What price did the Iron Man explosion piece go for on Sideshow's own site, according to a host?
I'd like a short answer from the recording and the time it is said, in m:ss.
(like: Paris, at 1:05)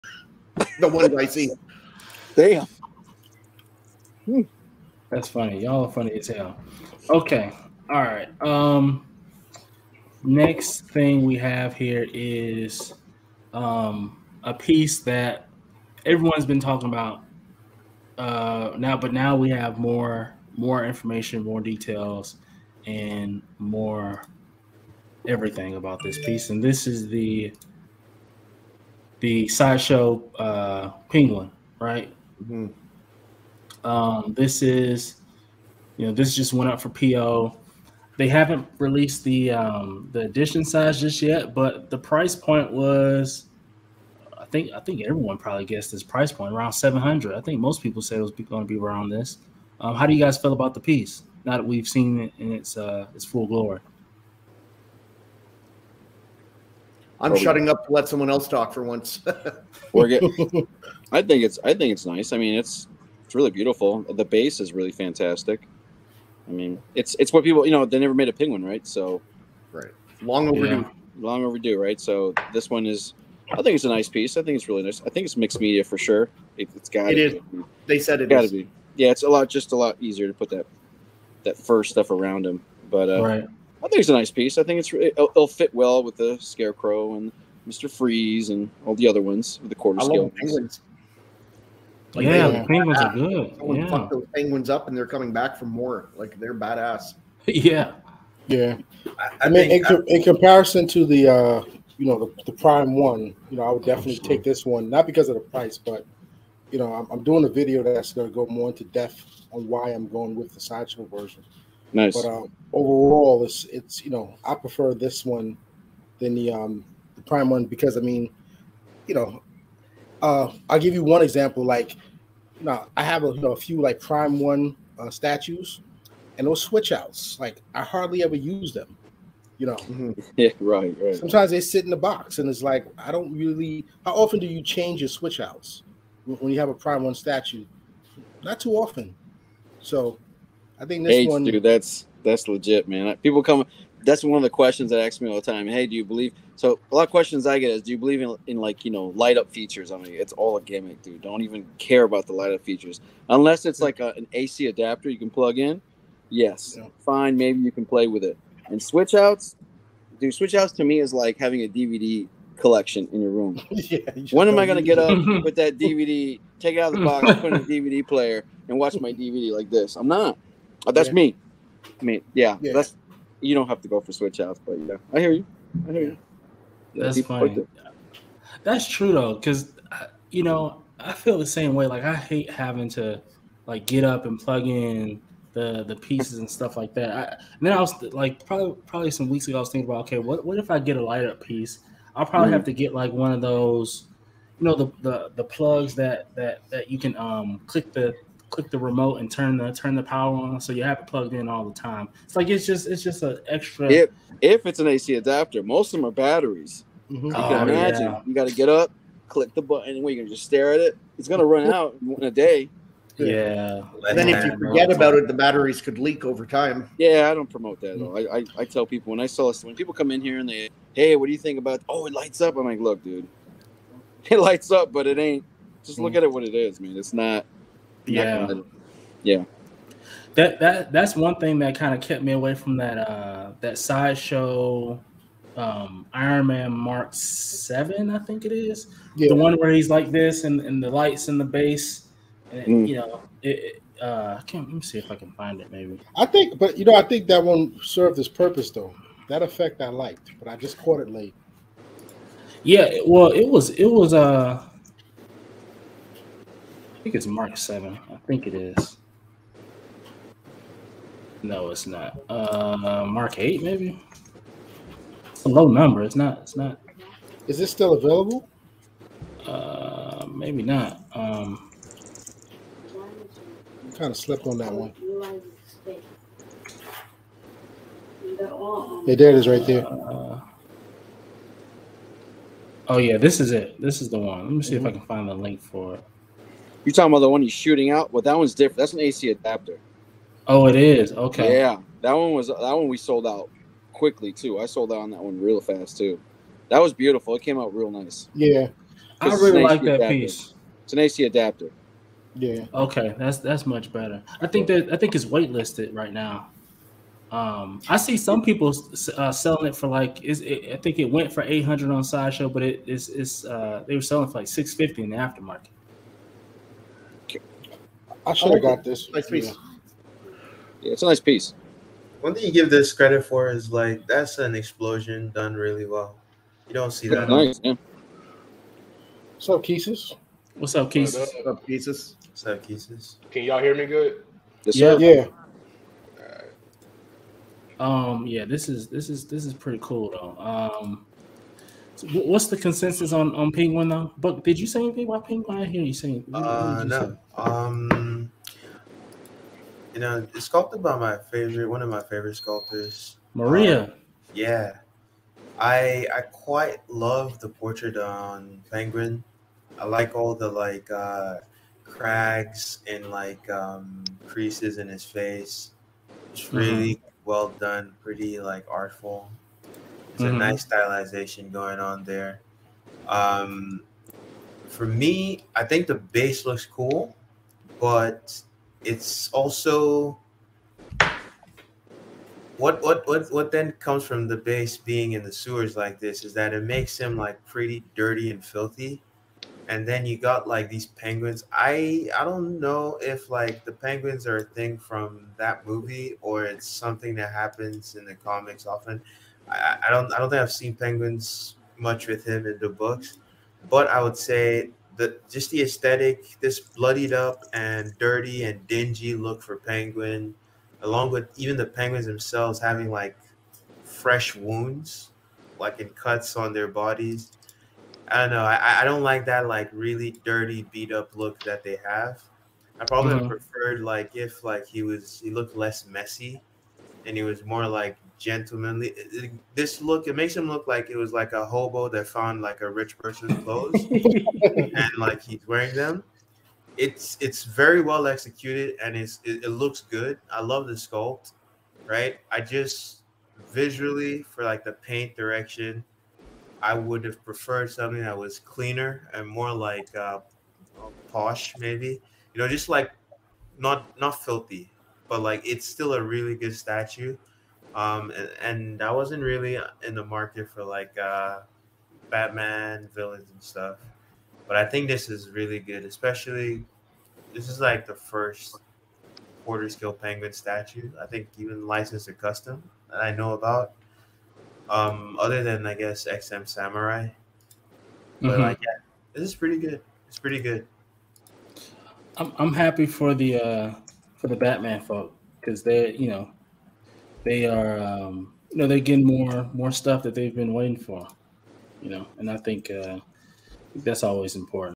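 800, at 5:11.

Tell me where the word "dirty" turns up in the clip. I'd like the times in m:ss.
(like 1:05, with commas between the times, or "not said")
6:27, 6:47, 7:00.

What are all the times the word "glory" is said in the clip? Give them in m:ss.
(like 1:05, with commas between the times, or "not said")
0:53.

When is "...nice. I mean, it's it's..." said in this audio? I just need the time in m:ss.
1:02.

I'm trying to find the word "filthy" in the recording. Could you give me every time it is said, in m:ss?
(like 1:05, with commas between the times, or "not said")
6:28, 7:34.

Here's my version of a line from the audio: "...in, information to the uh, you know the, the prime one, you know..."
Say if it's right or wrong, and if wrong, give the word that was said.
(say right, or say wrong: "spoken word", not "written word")
wrong: "comparison", not "information".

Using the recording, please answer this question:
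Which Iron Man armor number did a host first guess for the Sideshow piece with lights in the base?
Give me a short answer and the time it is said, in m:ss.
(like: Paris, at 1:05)
Mark 7, at 3:56.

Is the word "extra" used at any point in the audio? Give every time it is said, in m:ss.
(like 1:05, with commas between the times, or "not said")
3:23.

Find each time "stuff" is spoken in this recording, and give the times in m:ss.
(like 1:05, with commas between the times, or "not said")
1:21, 3:06, 7:43, 8:09.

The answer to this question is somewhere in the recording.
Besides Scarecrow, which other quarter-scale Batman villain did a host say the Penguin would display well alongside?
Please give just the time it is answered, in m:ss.
1:27.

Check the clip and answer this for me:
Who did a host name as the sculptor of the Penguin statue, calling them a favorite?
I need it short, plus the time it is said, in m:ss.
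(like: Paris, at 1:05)
Maria, at 5:53.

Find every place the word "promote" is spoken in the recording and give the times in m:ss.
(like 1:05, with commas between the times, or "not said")
3:37.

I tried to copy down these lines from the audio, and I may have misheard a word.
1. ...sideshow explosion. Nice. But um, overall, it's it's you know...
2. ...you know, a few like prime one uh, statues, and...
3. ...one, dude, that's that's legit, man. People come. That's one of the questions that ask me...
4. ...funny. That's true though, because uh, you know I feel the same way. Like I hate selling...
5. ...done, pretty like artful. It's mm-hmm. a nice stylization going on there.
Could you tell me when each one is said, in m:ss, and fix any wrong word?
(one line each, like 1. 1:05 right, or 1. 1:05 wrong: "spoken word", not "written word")
1. 1:50 wrong: "version", not "explosion"
2. 2:03 right
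3. 2:21 right
4. 2:57 wrong: "having", not "selling"
5. 6:07 right.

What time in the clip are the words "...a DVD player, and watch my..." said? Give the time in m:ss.
2:47.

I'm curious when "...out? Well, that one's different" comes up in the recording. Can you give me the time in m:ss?
4:47.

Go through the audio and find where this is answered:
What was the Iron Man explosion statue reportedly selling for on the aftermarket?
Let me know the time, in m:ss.
5:14.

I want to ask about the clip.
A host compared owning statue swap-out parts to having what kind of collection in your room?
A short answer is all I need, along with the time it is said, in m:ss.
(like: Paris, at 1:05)
DVD collection, at 2:41.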